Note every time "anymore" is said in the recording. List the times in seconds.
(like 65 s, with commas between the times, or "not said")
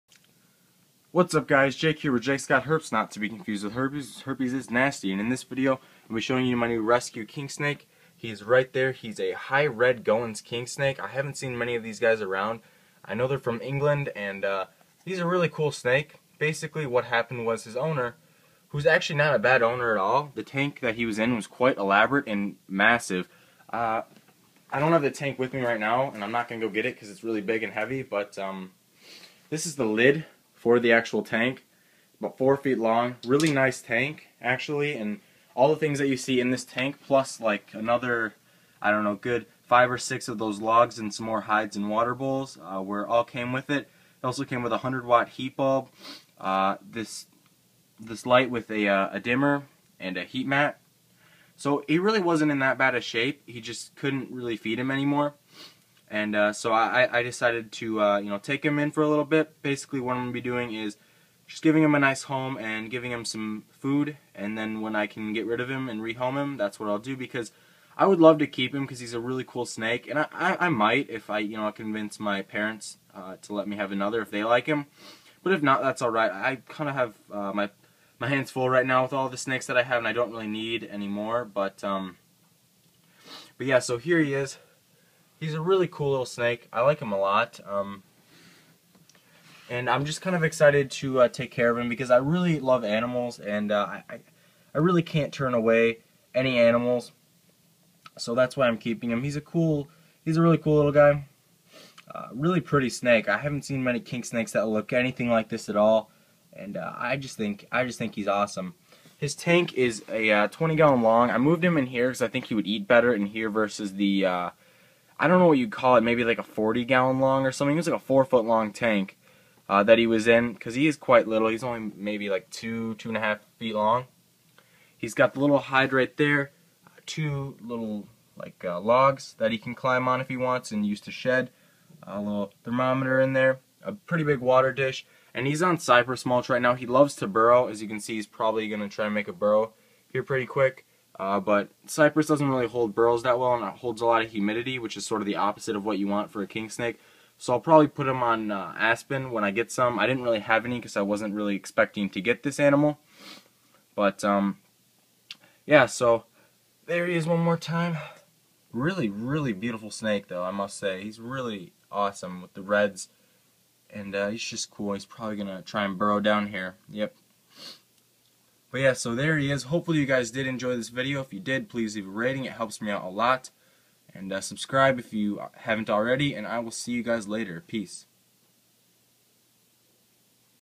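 54 s, 80 s.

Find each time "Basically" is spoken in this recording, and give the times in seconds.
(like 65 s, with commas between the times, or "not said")
16 s, 59 s.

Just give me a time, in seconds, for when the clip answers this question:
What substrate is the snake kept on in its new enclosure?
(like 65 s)
135 s.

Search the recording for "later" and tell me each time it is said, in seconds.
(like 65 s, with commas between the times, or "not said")
177 s.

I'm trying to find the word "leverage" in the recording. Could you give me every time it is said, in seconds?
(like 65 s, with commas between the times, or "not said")
not said.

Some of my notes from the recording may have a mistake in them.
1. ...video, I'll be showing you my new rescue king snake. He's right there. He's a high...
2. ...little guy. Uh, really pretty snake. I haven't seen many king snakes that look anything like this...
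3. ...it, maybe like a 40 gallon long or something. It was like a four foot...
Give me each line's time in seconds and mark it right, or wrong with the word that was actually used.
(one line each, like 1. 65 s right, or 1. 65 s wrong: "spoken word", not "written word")
1. 5 s right
2. 100 s right
3. 115 s right.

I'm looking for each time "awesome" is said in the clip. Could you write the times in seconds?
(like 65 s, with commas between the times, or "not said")
108 s, 161 s.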